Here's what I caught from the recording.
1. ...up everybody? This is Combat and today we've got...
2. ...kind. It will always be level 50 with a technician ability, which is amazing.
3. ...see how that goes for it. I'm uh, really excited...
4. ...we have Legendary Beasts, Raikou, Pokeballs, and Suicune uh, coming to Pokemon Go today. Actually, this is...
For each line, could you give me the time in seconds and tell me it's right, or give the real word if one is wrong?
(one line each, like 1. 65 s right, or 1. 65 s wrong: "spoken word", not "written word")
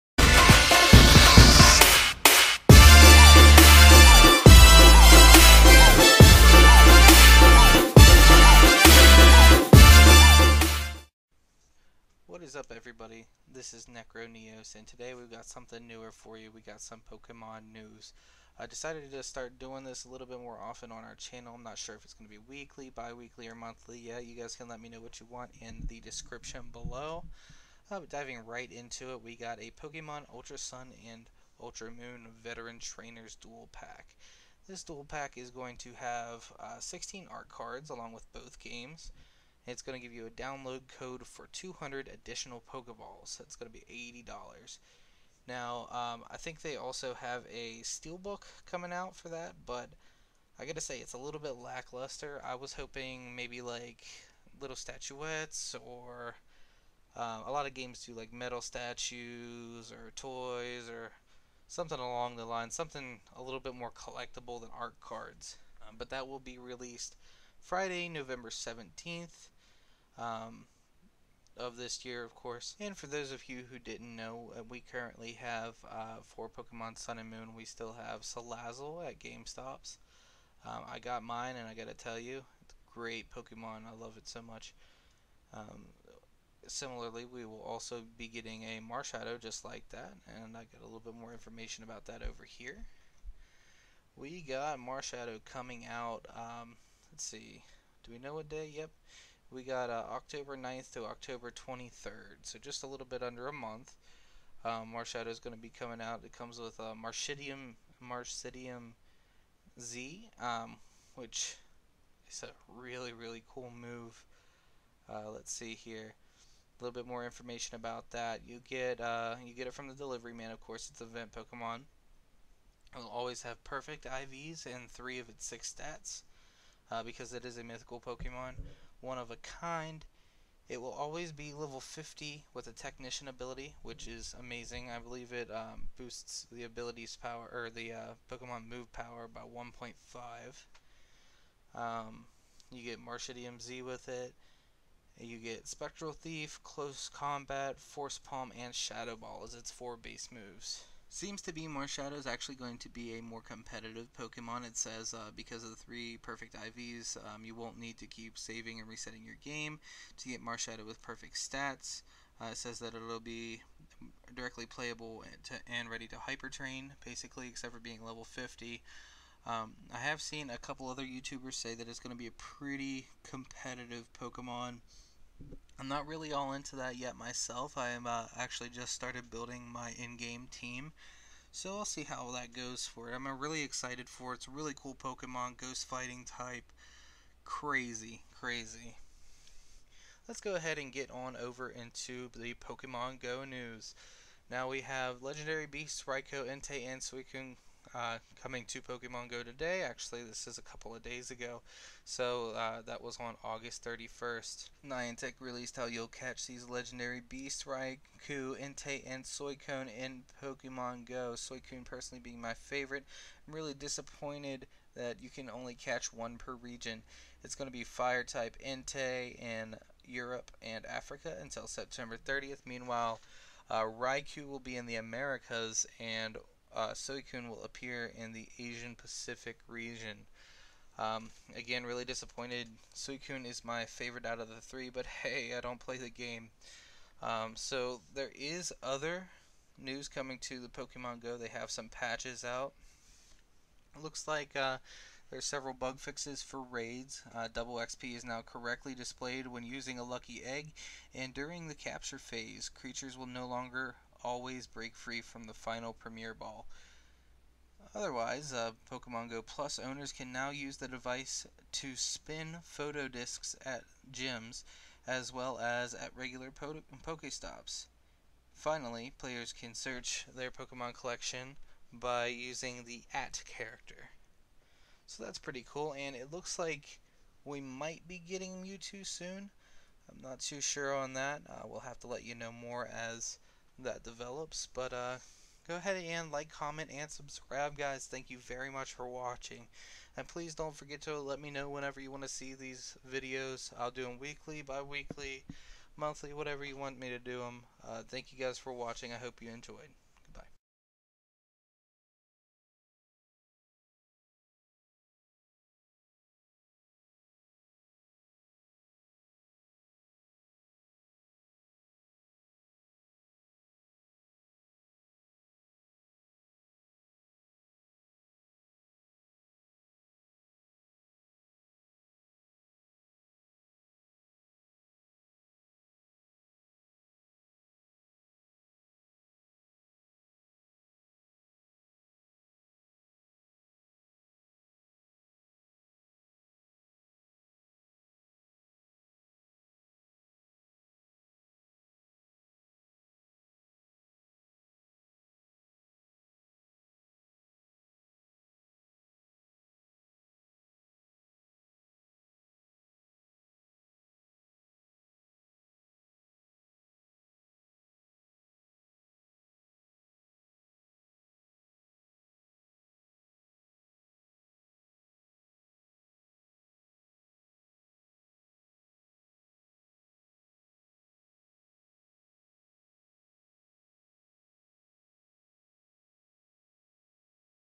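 1. 12 s wrong: "Necroneos", not "Combat"
2. 129 s right
3. 181 s right
4. 194 s wrong: "Entei", not "Pokeballs".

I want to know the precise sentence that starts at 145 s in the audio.
You get Spectral Thief, Close Combat, Force Palm, and Shadow Ball as its four base moves.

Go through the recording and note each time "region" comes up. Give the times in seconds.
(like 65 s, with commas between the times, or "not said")
216 s, 229 s.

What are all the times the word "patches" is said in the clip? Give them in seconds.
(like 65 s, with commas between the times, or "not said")
241 s.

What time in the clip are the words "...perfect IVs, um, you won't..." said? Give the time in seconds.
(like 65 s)
156 s.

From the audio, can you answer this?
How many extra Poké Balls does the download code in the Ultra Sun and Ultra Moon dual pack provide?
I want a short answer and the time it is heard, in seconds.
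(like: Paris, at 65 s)
200, at 41 s.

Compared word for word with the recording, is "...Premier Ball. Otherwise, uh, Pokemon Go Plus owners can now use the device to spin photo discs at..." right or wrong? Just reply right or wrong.
right.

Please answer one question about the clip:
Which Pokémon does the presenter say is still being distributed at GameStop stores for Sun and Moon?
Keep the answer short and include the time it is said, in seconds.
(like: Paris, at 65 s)
Salazzle, at 78 s.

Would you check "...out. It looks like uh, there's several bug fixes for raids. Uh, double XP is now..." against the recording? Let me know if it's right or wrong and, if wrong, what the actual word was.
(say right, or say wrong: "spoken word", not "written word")
right.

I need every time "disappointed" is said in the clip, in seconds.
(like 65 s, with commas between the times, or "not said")
213 s, 232 s.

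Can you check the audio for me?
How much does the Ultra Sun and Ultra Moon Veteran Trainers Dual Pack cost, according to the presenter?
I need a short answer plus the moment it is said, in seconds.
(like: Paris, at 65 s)
$80, at 44 s.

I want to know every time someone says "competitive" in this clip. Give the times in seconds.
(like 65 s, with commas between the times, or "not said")
153 s, 173 s.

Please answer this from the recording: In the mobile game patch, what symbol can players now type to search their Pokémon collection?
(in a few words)
at character.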